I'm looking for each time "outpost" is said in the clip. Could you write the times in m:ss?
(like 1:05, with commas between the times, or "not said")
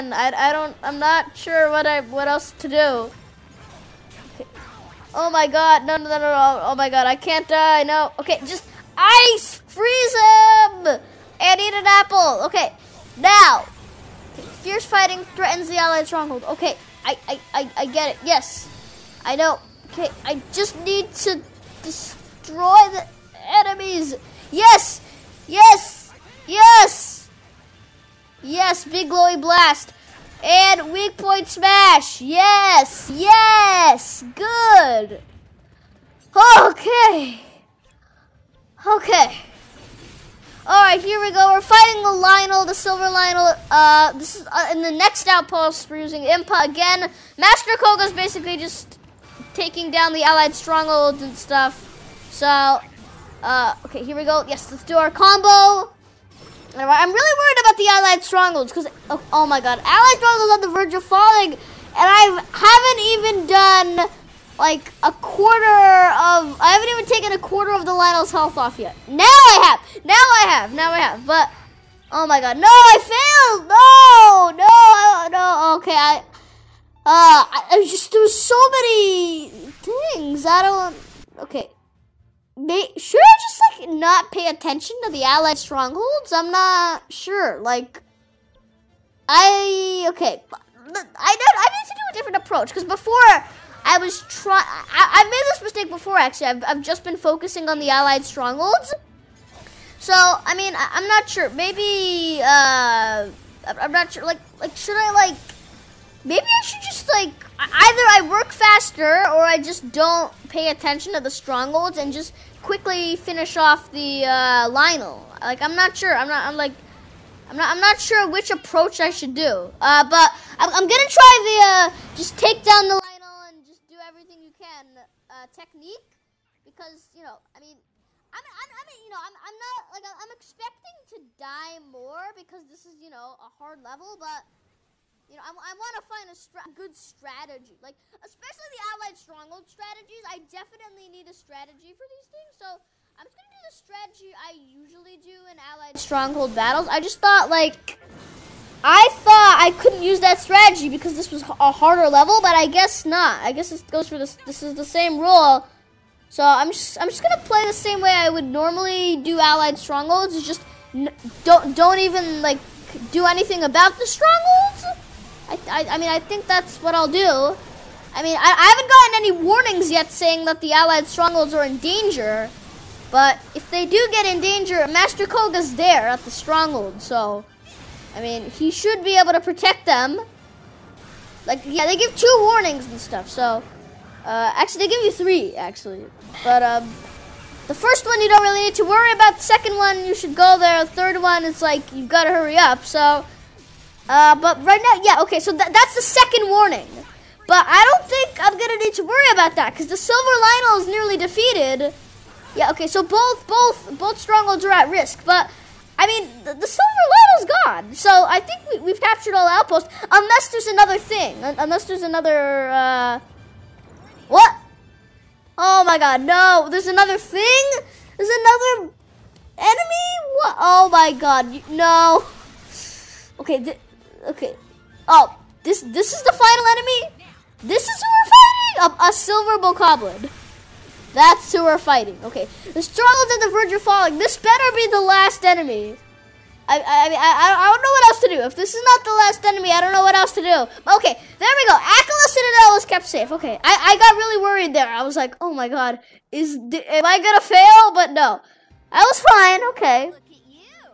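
0:45, 3:29.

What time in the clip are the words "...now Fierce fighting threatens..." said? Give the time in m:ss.
0:13.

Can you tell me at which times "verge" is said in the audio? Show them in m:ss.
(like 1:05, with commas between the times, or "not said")
1:00, 3:53.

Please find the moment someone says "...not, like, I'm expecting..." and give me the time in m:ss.
2:09.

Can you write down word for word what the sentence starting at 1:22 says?
May, should I just, like, not pay attention to the allied strongholds?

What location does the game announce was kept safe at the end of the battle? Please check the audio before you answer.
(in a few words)
Akkala Citadel.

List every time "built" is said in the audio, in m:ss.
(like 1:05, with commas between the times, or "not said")
not said.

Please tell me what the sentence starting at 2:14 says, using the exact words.
But, you know, I, I want to find a stra good strategy.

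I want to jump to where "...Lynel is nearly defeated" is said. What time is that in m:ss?
3:20.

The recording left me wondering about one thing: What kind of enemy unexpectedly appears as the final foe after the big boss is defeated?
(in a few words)
silver bokoblin.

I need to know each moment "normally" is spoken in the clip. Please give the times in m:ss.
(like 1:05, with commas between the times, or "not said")
2:38.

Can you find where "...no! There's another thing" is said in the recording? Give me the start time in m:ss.
3:36.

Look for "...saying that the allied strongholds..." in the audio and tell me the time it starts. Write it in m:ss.
2:50.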